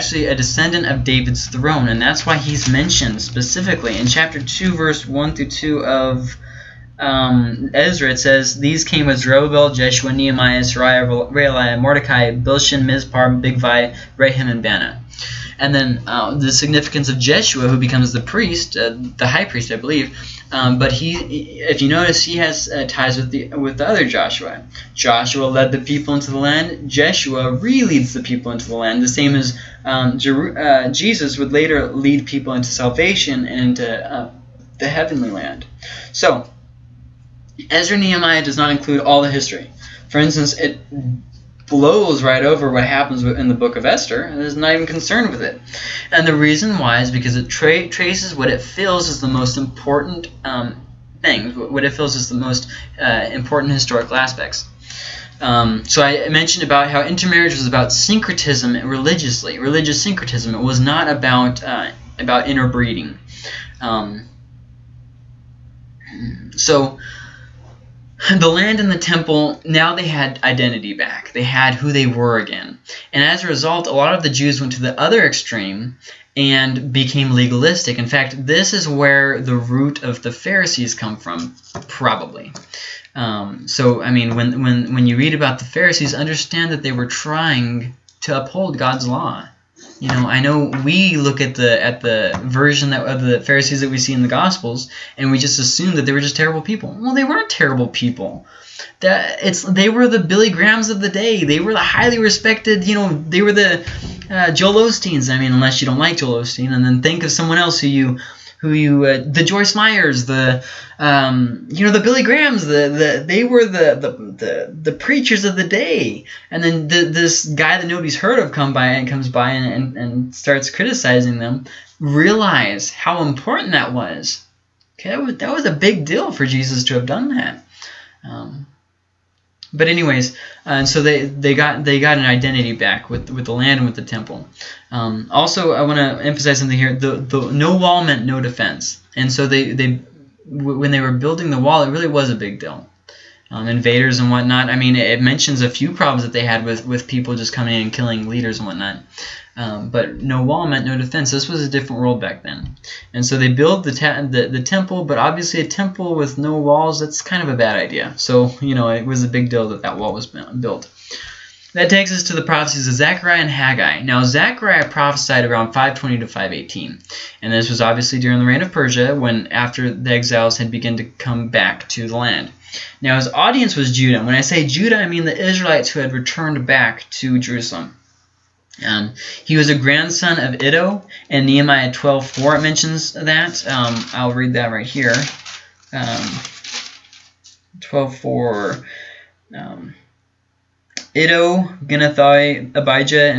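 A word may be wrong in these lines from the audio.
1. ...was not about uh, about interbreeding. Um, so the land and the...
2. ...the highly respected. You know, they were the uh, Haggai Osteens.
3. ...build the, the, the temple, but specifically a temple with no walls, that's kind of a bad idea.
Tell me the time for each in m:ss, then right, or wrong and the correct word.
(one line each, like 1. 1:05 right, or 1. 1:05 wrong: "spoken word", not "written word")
1. 1:00 right
2. 1:41 wrong: "Joel", not "Haggai"
3. 2:33 wrong: "obviously", not "specifically".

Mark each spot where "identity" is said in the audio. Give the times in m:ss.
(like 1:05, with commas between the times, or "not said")
1:10, 2:12.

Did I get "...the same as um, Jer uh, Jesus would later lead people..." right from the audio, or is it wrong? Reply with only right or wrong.
right.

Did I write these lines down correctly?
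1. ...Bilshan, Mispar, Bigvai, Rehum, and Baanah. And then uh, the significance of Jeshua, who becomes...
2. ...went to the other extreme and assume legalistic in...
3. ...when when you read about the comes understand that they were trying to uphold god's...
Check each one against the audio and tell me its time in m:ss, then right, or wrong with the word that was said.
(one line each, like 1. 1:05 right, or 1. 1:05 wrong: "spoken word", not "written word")
1. 0:12 right
2. 1:14 wrong: "became", not "assume"
3. 1:24 wrong: "pharisees", not "comes".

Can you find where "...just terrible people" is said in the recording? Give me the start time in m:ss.
1:36.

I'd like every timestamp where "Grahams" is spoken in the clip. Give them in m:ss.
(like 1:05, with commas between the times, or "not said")
1:40, 1:52.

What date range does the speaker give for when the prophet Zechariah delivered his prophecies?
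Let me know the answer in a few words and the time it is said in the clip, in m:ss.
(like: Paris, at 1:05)
520 to 518, at 2:45.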